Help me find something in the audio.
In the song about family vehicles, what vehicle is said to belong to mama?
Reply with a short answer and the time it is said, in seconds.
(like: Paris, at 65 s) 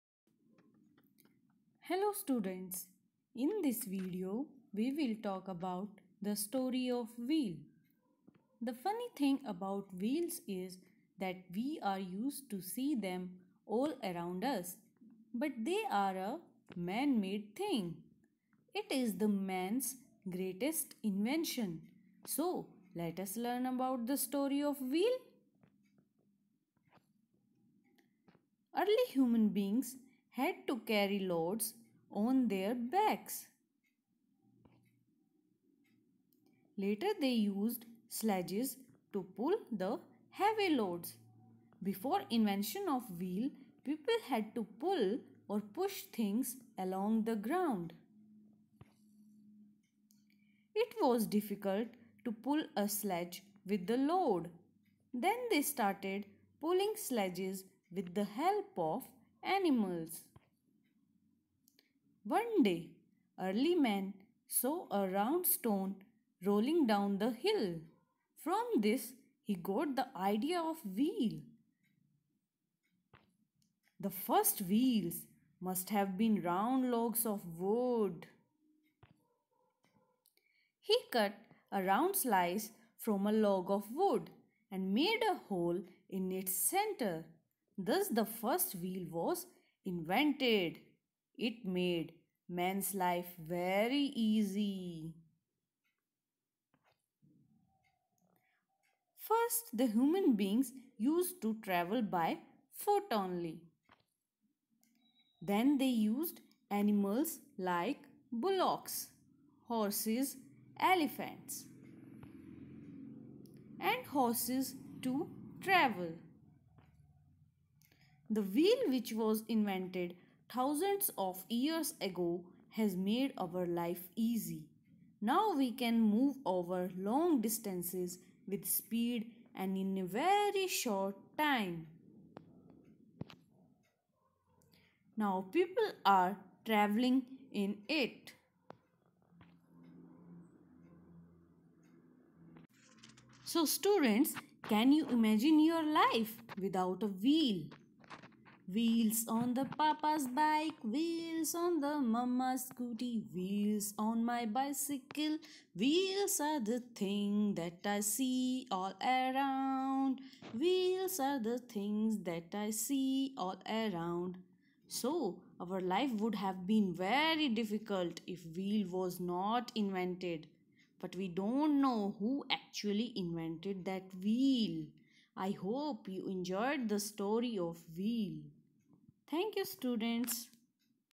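Scooty, at 152 s.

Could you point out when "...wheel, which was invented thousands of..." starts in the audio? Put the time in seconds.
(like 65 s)
118 s.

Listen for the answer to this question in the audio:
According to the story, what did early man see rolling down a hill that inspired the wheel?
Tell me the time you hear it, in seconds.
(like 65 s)
65 s.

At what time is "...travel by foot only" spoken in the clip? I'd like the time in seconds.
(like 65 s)
101 s.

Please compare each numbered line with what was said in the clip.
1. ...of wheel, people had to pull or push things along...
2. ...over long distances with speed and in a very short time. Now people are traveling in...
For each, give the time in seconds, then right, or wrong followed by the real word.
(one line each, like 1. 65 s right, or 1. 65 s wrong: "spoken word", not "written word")
1. 42 s right
2. 126 s right.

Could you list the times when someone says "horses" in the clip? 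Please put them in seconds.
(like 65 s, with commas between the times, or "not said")
109 s, 114 s.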